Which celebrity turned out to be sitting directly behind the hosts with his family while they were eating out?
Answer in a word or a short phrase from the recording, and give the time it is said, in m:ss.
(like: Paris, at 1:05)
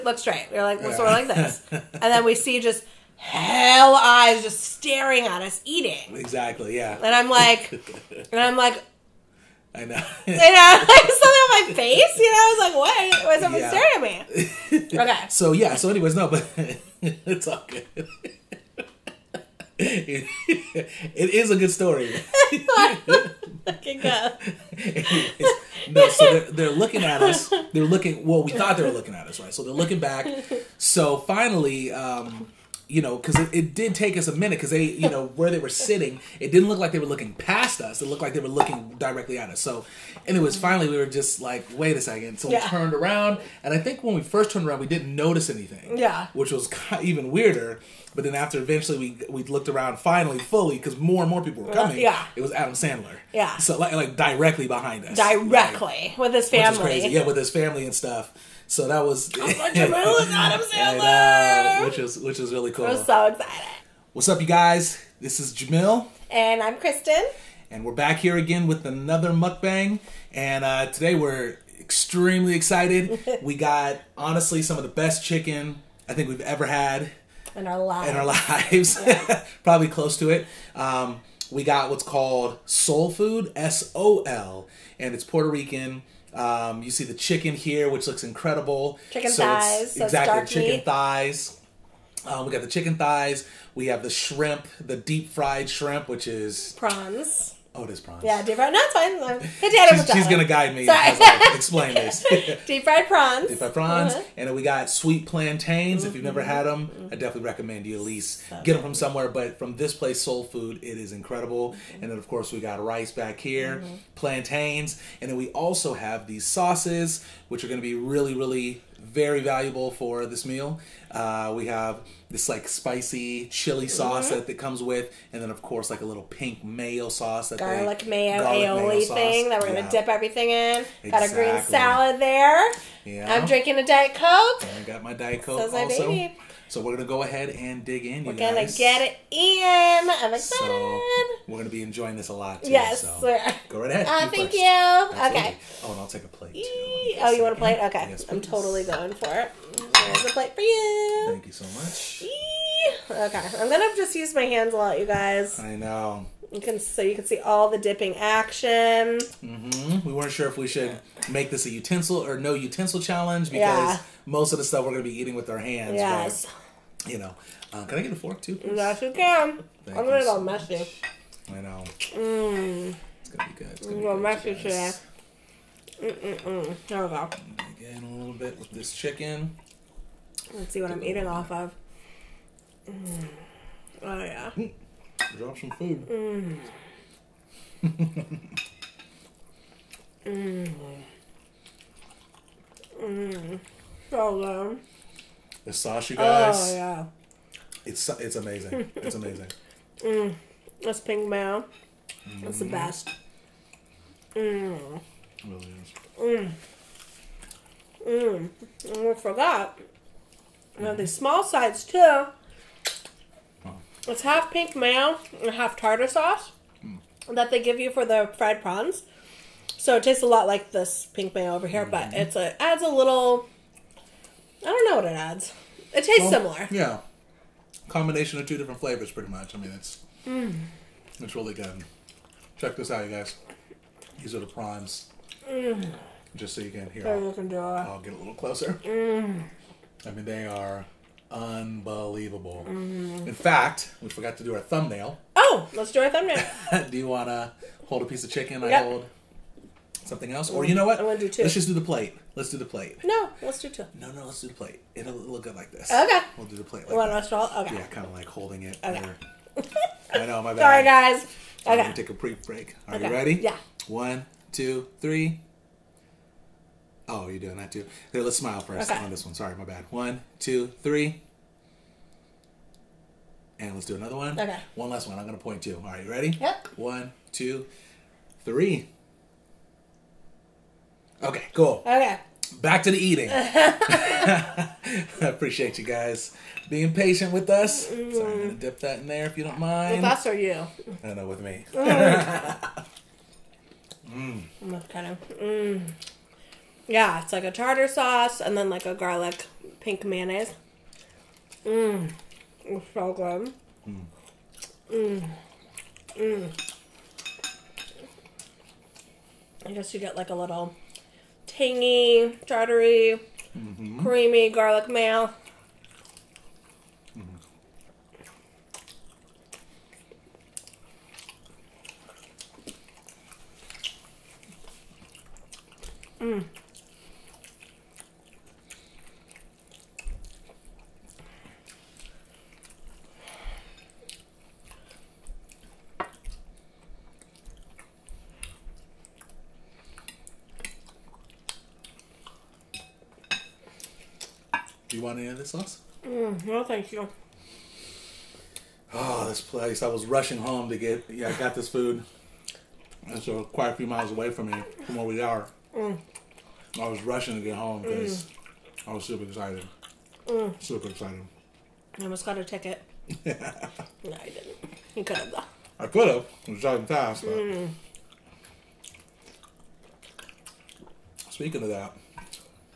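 Adam Sandler, at 0:52.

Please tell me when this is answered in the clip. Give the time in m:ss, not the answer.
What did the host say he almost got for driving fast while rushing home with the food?
6:02.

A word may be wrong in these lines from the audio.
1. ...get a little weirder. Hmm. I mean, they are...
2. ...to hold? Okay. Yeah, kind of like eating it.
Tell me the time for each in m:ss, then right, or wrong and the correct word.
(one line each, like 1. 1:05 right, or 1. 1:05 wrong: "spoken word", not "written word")
1. 3:57 wrong: "closer", not "weirder"
2. 4:17 wrong: "holding", not "eating".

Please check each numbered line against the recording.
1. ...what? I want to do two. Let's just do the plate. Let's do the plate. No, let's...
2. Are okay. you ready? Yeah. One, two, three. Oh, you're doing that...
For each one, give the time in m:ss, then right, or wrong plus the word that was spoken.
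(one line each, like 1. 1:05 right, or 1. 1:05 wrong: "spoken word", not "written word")
1. 4:10 right
2. 4:22 right.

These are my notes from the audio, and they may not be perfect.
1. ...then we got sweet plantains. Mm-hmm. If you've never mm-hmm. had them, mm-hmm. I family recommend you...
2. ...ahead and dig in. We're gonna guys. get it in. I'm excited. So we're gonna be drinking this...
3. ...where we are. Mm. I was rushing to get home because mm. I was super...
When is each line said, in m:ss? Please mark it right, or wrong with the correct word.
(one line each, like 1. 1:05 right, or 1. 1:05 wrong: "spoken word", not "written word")
1. 1:44 wrong: "definitely", not "family"
2. 2:17 wrong: "enjoying", not "drinking"
3. 5:54 right.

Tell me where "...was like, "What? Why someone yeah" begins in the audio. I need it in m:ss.
0:13.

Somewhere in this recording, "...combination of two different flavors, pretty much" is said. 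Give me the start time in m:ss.
3:47.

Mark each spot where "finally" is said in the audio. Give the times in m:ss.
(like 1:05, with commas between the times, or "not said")
0:31, 0:40, 0:49.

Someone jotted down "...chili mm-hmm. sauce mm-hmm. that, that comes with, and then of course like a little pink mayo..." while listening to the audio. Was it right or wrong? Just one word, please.
right.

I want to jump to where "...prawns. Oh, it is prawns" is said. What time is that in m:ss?
1:36.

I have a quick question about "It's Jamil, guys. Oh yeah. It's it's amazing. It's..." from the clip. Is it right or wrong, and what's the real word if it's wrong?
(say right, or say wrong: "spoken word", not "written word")
wrong: "Sasha", not "Jamil".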